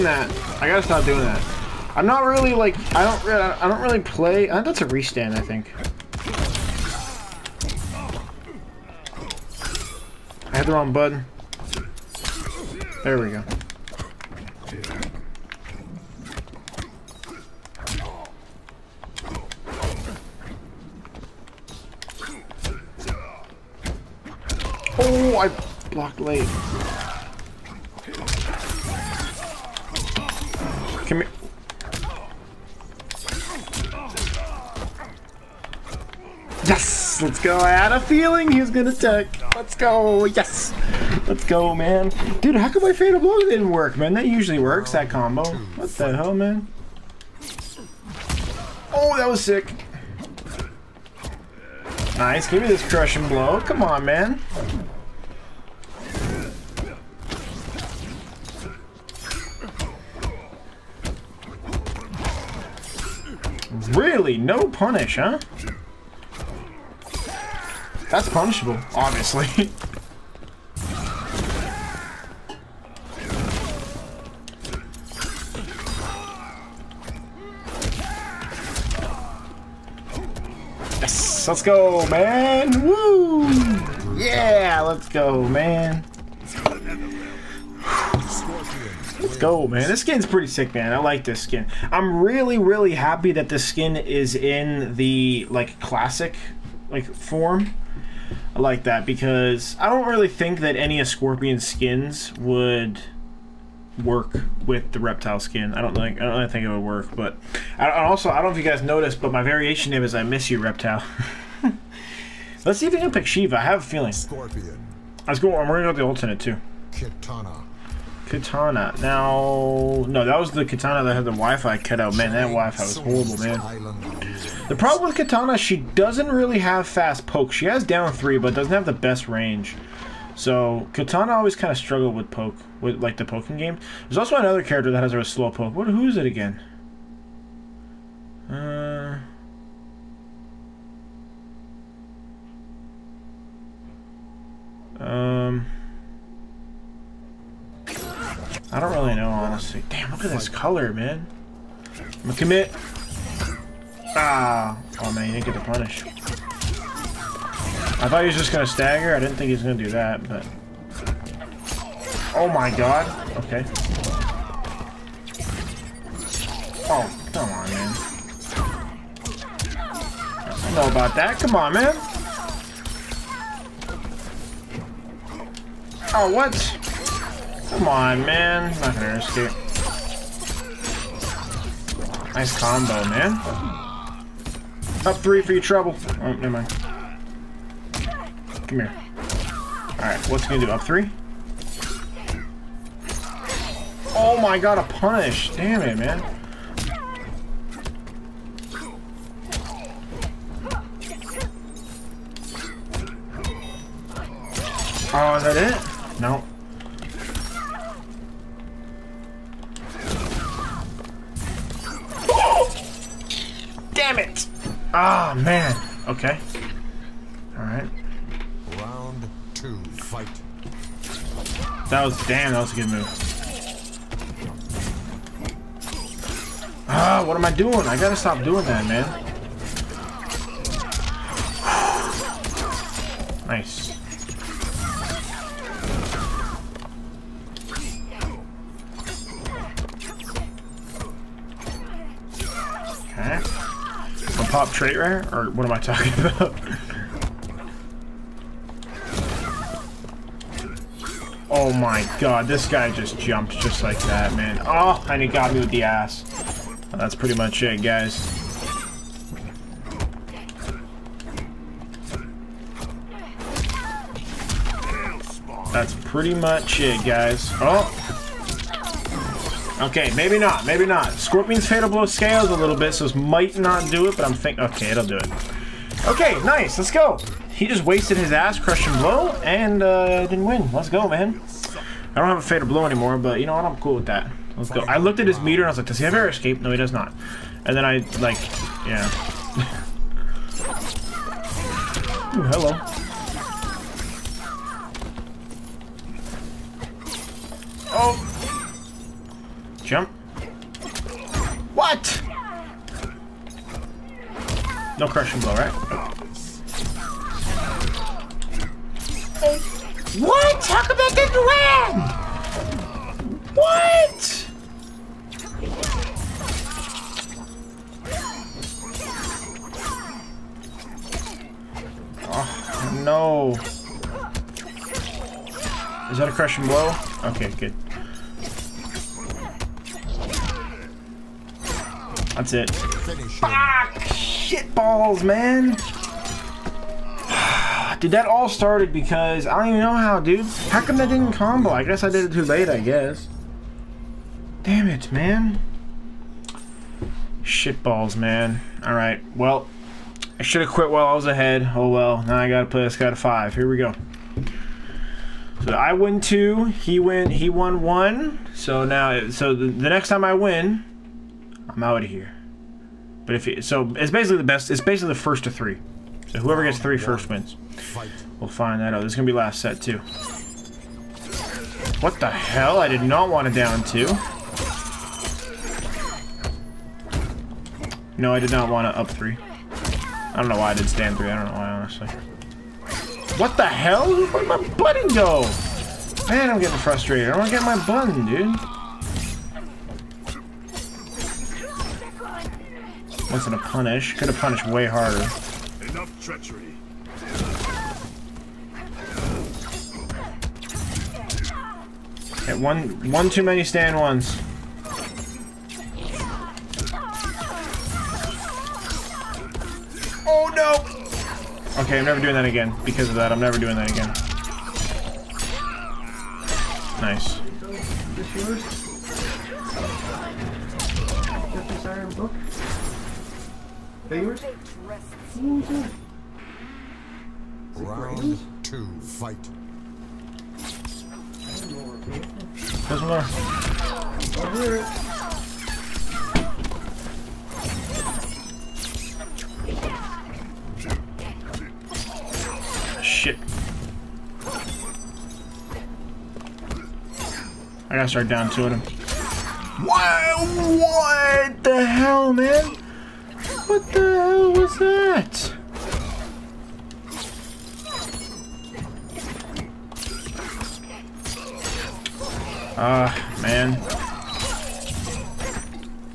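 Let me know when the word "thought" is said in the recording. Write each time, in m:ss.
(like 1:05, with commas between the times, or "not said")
2:38.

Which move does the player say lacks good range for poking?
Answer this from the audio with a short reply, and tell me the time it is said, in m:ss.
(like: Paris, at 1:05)
down three, at 2:07.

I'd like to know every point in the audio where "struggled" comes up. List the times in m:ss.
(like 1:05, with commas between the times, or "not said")
2:11.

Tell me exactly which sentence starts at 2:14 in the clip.
There's also another character that has a slow poke.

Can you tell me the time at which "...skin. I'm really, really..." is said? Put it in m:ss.
1:31.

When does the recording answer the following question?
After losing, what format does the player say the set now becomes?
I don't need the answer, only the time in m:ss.
6:04.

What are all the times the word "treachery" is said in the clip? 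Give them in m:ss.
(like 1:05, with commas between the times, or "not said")
6:36.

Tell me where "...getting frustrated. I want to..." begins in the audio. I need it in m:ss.
6:26.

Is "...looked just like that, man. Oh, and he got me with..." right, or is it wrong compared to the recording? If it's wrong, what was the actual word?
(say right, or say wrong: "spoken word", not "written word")
wrong: "jumped", not "looked".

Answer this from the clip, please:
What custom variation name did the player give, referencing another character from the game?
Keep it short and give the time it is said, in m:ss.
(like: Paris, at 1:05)
I miss you reptile, at 1:50.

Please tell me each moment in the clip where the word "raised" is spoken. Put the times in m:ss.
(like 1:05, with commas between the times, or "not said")
not said.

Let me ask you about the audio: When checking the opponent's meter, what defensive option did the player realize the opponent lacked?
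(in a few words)
air escape.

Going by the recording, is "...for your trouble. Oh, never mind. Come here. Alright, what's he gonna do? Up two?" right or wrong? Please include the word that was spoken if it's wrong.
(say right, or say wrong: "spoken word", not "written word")
wrong: "three", not "two".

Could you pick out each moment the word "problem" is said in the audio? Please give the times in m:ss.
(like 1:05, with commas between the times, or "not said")
2:04.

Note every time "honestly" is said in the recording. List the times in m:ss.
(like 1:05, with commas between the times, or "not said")
2:29, 6:21.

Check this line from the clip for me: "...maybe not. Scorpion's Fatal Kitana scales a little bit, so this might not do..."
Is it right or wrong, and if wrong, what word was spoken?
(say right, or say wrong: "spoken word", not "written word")
wrong: "Blow", not "Kitana".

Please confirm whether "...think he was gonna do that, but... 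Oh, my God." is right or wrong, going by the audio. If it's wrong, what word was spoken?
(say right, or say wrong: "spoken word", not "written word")
right.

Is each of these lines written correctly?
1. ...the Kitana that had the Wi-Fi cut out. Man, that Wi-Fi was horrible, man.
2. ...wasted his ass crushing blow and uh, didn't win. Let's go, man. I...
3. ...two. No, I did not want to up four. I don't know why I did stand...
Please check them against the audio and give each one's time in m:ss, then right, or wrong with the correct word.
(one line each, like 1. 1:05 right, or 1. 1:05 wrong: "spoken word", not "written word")
1. 2:00 right
2. 4:37 right
3. 6:13 wrong: "three", not "four".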